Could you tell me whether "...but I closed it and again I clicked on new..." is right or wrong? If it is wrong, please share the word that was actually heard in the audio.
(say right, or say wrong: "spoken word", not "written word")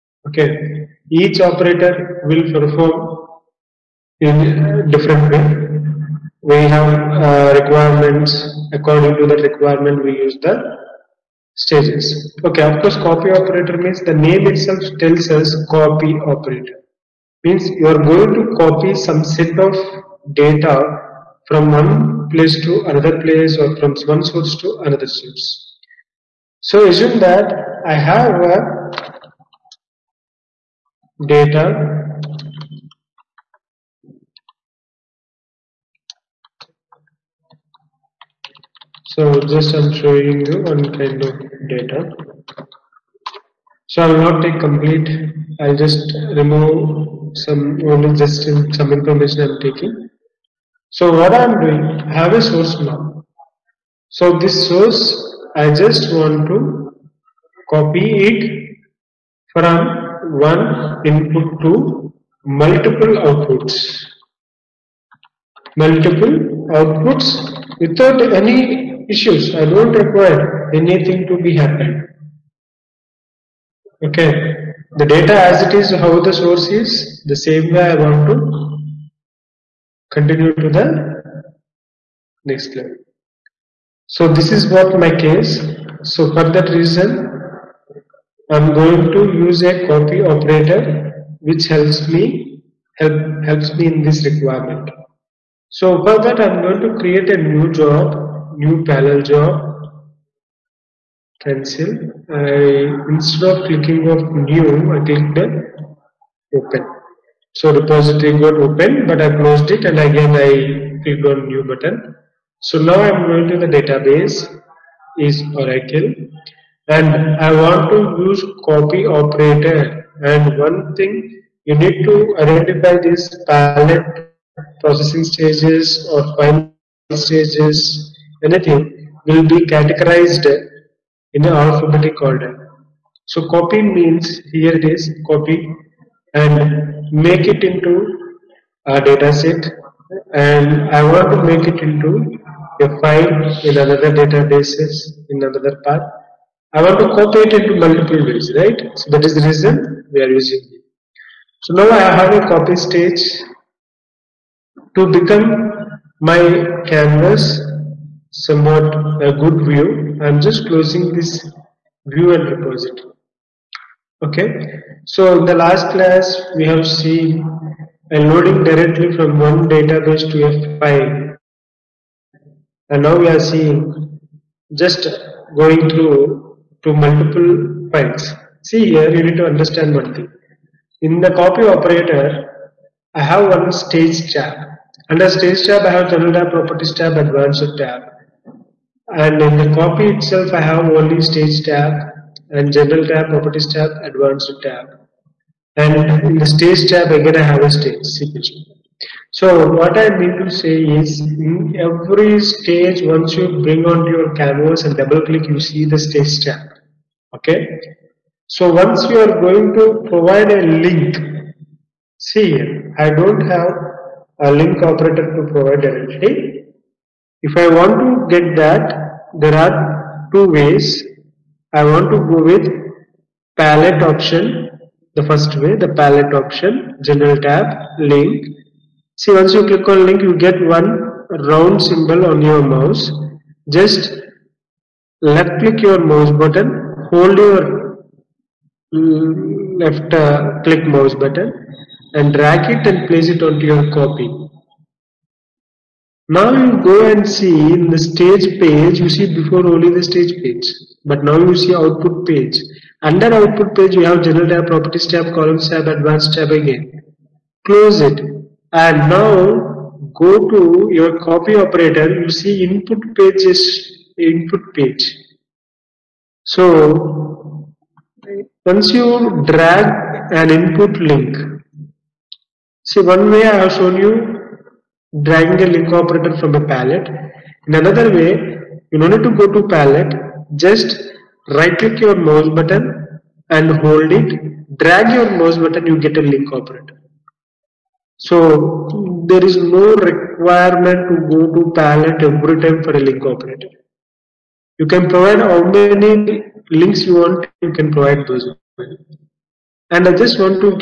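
right.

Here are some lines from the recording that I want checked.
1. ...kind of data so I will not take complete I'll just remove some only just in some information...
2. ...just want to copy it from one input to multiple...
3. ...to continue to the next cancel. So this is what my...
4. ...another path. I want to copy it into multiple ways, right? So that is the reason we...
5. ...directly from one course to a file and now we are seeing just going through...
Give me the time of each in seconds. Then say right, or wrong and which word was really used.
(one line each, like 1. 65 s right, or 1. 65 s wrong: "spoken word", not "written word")
1. 40 s right
2. 55 s right
3. 78 s wrong: "level", not "cancel"
4. 145 s right
5. 168 s wrong: "database", not "course".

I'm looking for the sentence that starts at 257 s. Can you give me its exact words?
Close it and now go to your copy operator, you see input page is input page.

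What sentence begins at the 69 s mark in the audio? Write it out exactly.
I don't require anything to be happened.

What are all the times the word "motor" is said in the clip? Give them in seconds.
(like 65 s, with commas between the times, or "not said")
not said.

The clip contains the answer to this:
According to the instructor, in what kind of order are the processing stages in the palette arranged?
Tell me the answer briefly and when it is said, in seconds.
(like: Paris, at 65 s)
Alphabetic order, at 131 s.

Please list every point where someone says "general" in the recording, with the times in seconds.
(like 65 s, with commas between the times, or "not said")
186 s, 192 s, 227 s, 254 s.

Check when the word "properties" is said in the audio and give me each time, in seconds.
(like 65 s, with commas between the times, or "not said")
186 s, 193 s, 254 s.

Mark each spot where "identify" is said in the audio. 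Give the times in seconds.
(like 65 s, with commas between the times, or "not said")
122 s.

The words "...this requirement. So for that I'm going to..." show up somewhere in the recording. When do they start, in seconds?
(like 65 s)
94 s.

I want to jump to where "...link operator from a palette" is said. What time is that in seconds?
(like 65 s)
275 s.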